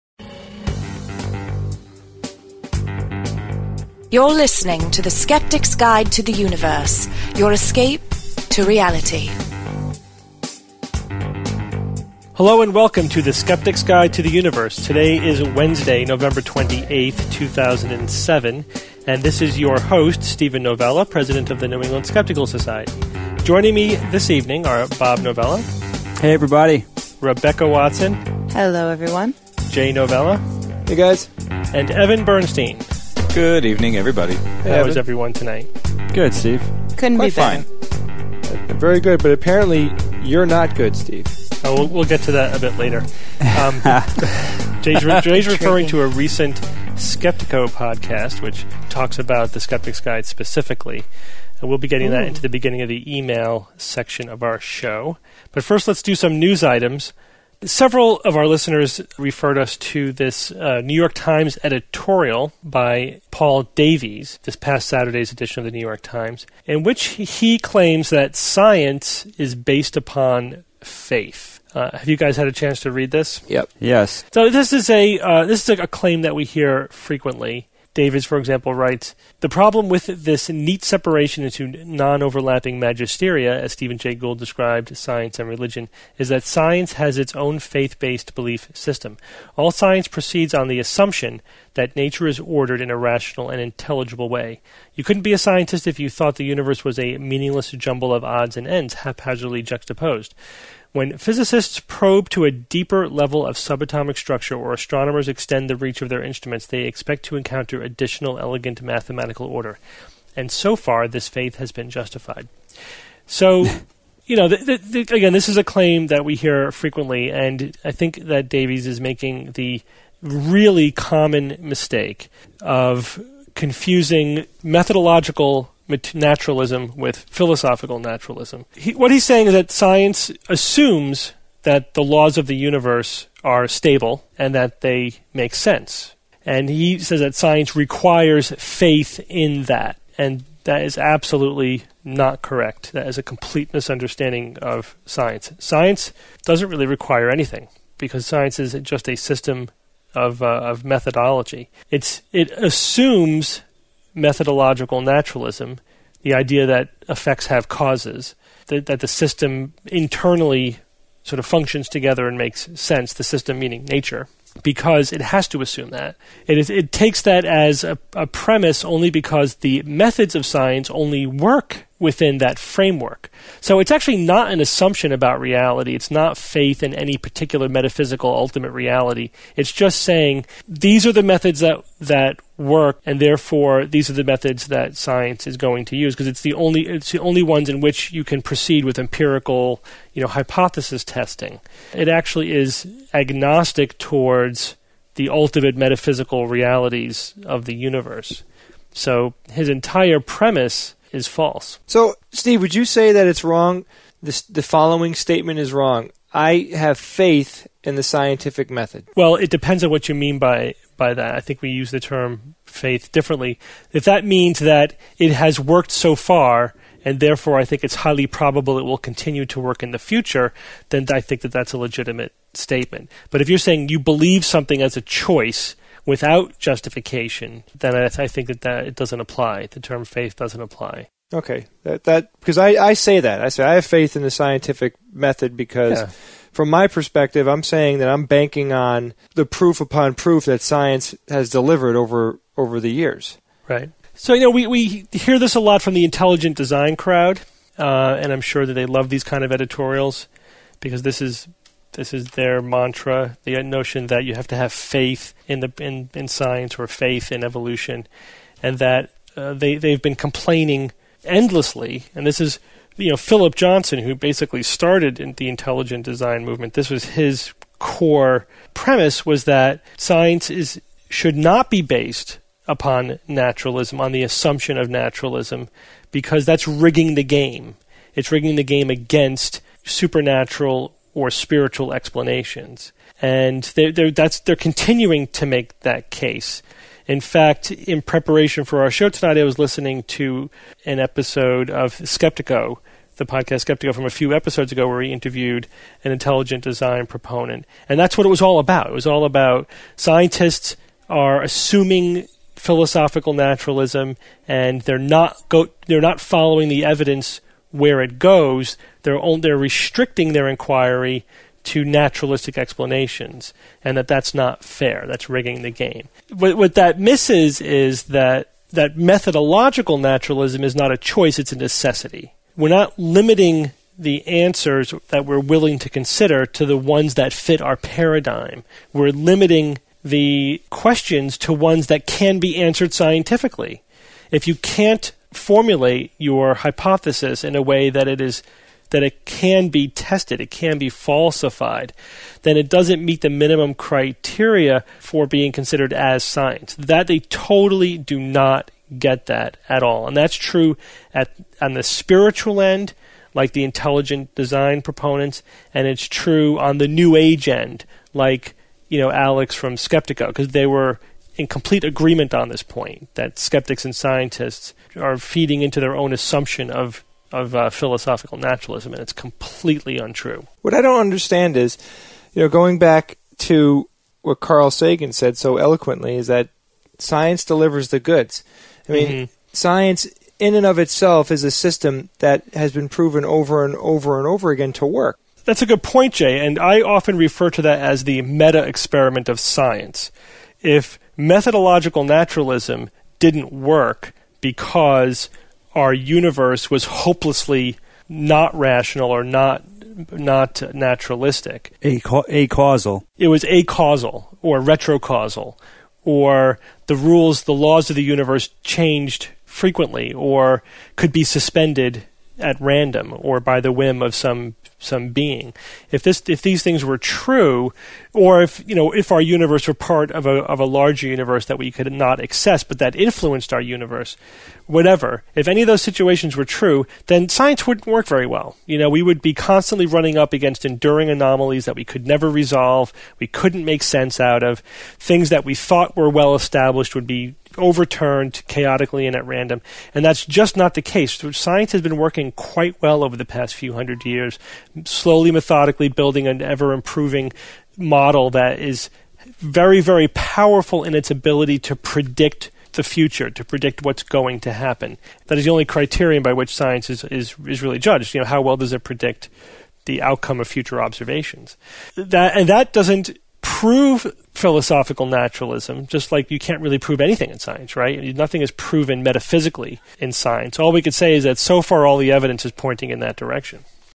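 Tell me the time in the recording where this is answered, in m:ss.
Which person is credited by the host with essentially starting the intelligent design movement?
4:23.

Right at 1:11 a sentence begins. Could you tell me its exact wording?
Uh, have you guys had a chance to read this?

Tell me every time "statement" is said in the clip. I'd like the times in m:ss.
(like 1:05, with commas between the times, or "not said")
3:25, 3:42.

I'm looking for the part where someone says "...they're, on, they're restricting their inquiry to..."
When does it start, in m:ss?
5:09.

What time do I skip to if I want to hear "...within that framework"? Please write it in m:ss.
2:52.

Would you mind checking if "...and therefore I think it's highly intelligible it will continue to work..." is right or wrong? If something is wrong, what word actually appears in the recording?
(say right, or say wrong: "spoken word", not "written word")
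wrong: "probable", not "intelligible".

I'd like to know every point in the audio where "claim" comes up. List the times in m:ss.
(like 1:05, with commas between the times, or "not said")
1:07, 1:15, 1:55.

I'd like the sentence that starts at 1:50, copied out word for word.
And so far, this faith has been justified.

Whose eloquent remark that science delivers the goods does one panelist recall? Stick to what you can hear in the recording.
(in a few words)
Carl Sagan.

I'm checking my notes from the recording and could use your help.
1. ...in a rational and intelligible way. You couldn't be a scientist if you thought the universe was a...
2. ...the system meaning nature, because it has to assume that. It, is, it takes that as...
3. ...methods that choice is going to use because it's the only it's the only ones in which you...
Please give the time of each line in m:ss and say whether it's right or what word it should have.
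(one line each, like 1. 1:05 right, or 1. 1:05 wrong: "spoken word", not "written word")
1. 1:32 right
2. 2:43 right
3. 3:04 wrong: "science", not "choice".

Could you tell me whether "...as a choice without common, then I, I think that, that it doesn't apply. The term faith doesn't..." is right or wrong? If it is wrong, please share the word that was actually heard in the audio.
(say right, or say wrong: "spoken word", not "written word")
wrong: "justification", not "common".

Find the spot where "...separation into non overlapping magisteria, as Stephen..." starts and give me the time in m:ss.
1:20.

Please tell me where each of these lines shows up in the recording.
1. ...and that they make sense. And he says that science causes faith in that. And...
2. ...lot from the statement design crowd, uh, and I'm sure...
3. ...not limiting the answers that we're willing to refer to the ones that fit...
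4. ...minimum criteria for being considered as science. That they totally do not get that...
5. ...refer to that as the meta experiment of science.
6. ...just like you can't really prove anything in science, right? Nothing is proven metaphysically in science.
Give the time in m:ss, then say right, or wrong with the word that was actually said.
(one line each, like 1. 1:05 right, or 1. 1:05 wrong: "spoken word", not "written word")
1. 2:14 wrong: "requires", not "causes"
2. 4:05 wrong: "intelligent", not "statement"
3. 5:22 wrong: "consider", not "refer"
4. 5:43 right
5. 6:27 right
6. 7:45 right.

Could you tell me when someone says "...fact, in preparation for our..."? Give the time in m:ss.
4:47.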